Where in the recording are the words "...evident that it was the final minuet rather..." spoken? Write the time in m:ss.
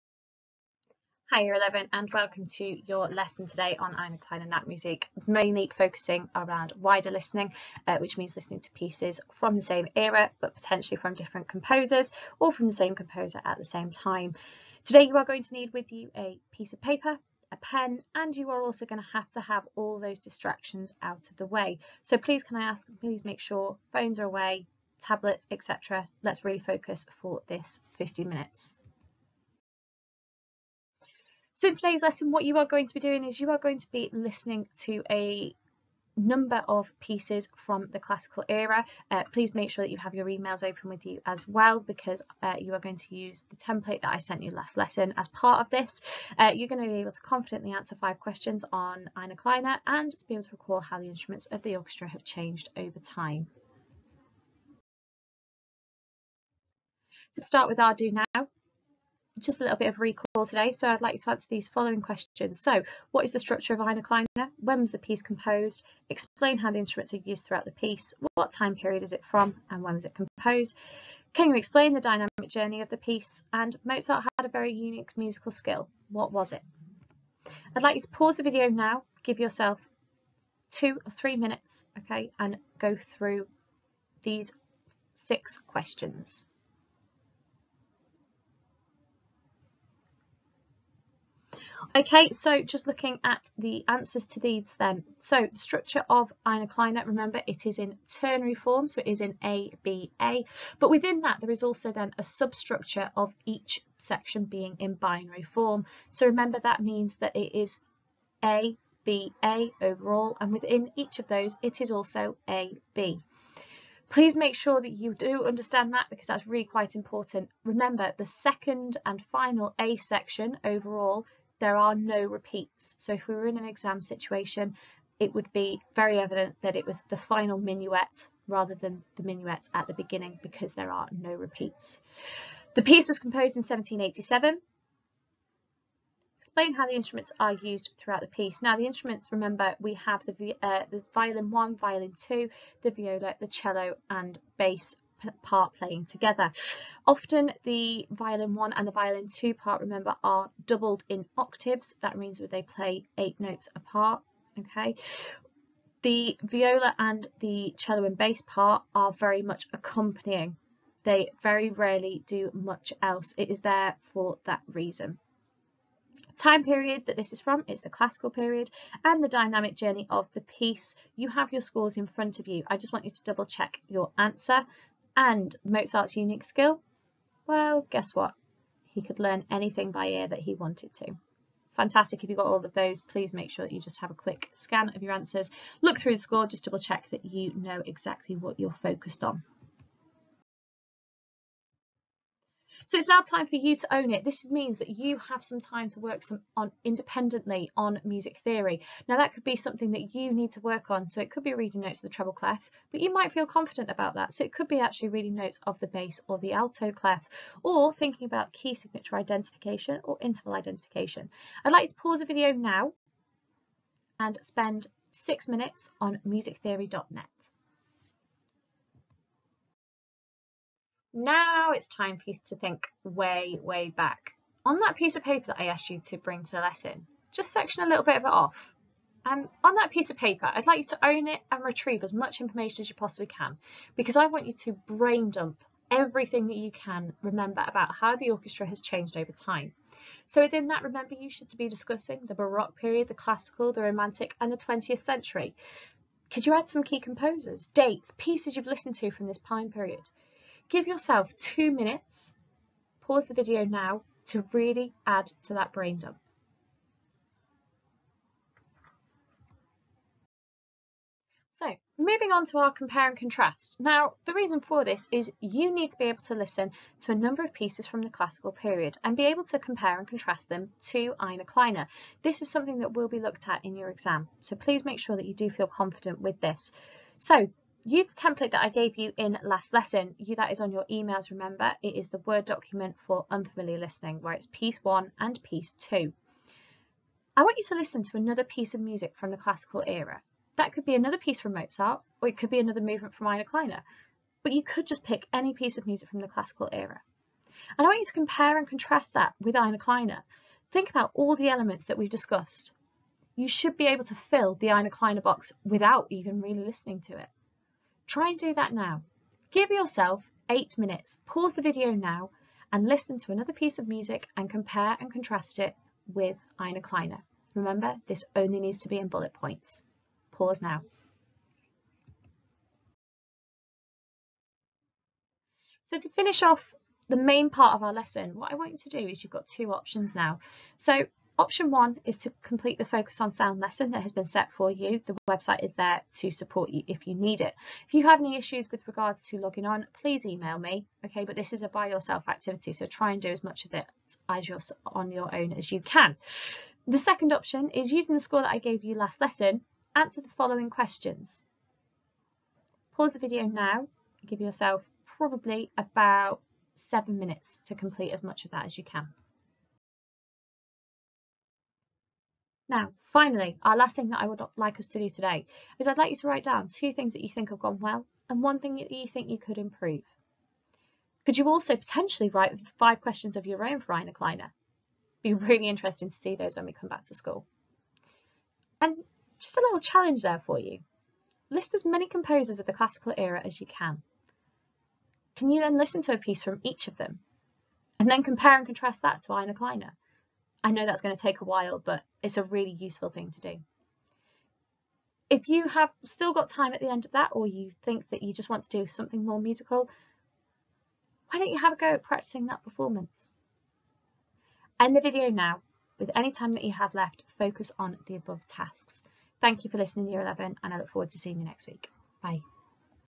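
2:06.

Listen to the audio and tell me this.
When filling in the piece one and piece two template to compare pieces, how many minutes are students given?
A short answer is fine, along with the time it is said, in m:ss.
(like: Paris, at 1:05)
8 minutes, at 5:10.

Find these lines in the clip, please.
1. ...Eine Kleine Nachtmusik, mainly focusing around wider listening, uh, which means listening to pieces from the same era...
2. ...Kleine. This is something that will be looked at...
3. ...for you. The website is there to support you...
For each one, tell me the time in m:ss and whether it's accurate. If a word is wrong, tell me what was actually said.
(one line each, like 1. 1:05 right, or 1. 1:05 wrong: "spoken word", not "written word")
1. 0:03 right
2. 4:31 right
3. 5:34 right.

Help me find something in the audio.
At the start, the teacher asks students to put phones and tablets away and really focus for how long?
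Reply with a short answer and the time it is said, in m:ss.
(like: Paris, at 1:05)
50 minutes, at 0:27.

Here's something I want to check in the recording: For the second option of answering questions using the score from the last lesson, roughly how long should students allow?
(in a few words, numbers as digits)
7 minutes.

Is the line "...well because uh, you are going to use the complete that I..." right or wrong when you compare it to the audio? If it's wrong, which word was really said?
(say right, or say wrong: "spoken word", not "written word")
wrong: "template", not "complete".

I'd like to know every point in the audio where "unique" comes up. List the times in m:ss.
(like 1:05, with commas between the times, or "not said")
1:14, 2:56.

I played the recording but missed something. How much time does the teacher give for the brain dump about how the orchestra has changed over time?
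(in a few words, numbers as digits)
2 minutes.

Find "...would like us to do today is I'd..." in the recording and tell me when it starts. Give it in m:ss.
6:04.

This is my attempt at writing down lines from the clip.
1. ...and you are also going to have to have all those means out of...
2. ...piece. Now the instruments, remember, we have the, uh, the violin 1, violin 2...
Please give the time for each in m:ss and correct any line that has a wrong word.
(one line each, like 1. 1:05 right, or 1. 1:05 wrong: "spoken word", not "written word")
1. 0:18 wrong: "distractions", not "means"
2. 2:18 right.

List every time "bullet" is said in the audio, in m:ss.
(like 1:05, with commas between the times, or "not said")
5:19.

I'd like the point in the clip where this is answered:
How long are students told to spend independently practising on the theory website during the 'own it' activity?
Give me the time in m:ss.
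3:35.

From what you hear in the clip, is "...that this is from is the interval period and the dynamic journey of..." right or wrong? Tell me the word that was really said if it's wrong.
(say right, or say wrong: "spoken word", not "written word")
wrong: "classical", not "interval".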